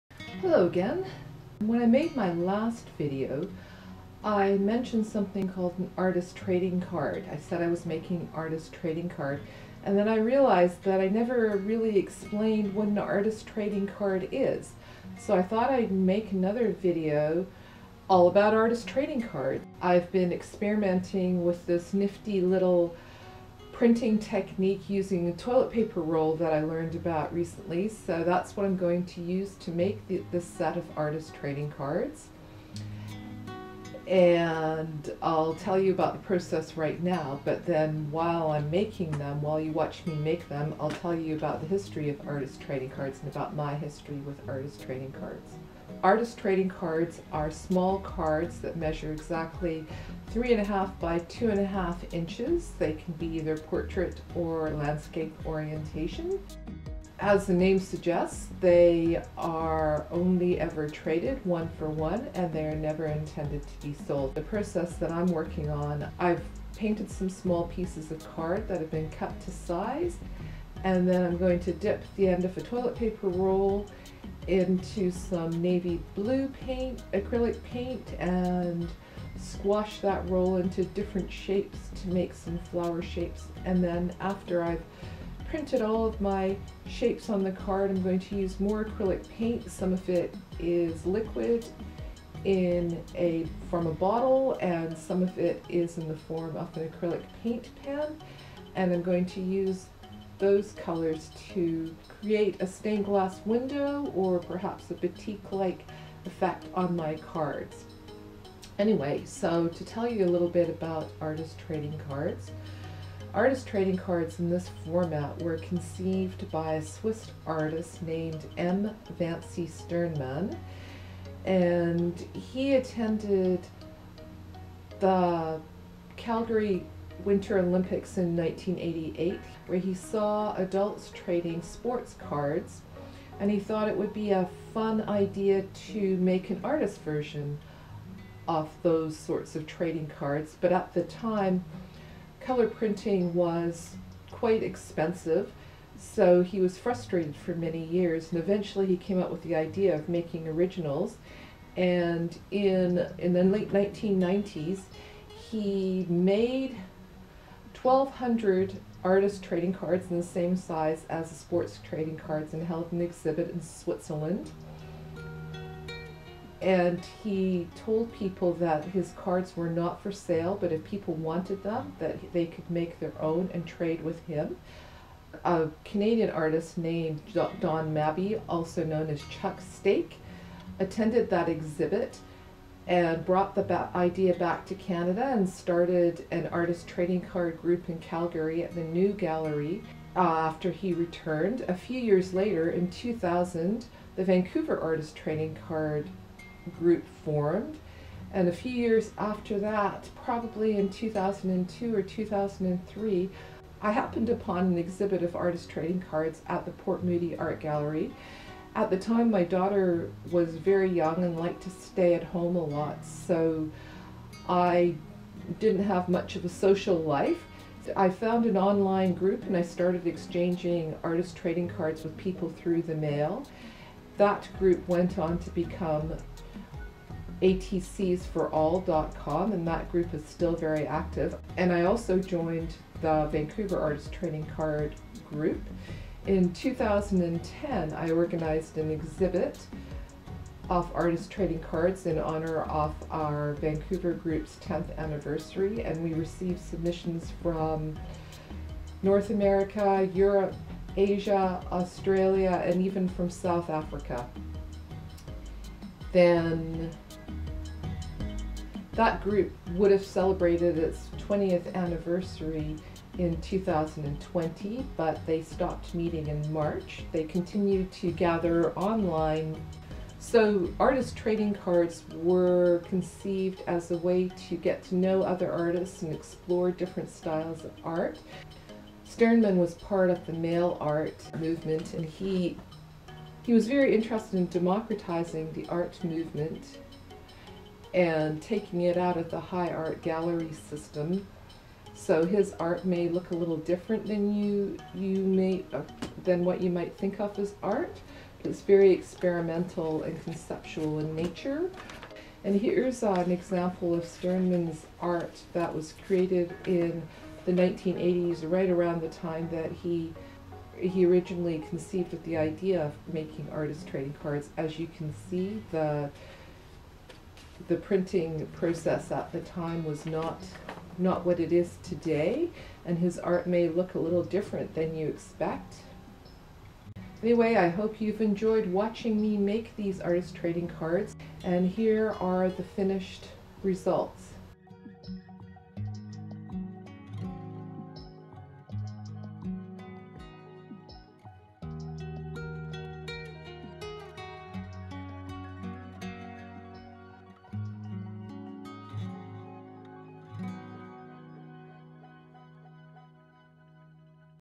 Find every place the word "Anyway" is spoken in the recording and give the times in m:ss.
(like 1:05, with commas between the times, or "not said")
1:48, 5:27.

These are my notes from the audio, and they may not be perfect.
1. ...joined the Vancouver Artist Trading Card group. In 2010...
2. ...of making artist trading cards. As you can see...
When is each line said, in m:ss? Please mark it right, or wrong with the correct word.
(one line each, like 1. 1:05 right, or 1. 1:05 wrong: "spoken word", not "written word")
1. 3:52 right
2. 5:12 right.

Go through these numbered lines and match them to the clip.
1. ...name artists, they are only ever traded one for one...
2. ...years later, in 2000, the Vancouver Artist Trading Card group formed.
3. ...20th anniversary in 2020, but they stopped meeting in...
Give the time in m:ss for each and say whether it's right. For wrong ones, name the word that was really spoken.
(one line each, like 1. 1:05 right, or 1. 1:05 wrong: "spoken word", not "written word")
1. 0:57 wrong: "suggests", not "artists"
2. 3:11 right
3. 4:21 right.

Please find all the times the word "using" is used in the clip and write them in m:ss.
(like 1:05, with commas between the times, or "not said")
0:24.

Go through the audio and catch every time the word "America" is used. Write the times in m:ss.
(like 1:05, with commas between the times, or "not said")
4:09.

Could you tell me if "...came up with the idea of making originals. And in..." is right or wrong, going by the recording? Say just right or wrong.
right.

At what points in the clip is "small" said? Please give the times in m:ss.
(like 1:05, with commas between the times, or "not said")
0:47, 1:07.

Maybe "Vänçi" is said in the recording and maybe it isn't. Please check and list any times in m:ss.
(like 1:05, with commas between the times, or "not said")
1:59.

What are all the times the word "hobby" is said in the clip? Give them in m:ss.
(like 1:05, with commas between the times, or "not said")
not said.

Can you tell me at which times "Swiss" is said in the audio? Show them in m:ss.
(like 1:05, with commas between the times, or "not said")
1:56.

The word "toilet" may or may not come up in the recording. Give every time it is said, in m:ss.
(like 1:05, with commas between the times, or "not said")
0:25, 1:12.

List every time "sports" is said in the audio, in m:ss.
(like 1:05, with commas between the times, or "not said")
2:11, 2:41.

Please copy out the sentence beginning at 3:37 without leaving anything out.
I found an online group and I started exchanging artist trading cards with people through the mail.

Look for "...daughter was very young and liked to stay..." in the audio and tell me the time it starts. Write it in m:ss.
3:29.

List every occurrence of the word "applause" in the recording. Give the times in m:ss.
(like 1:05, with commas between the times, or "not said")
not said.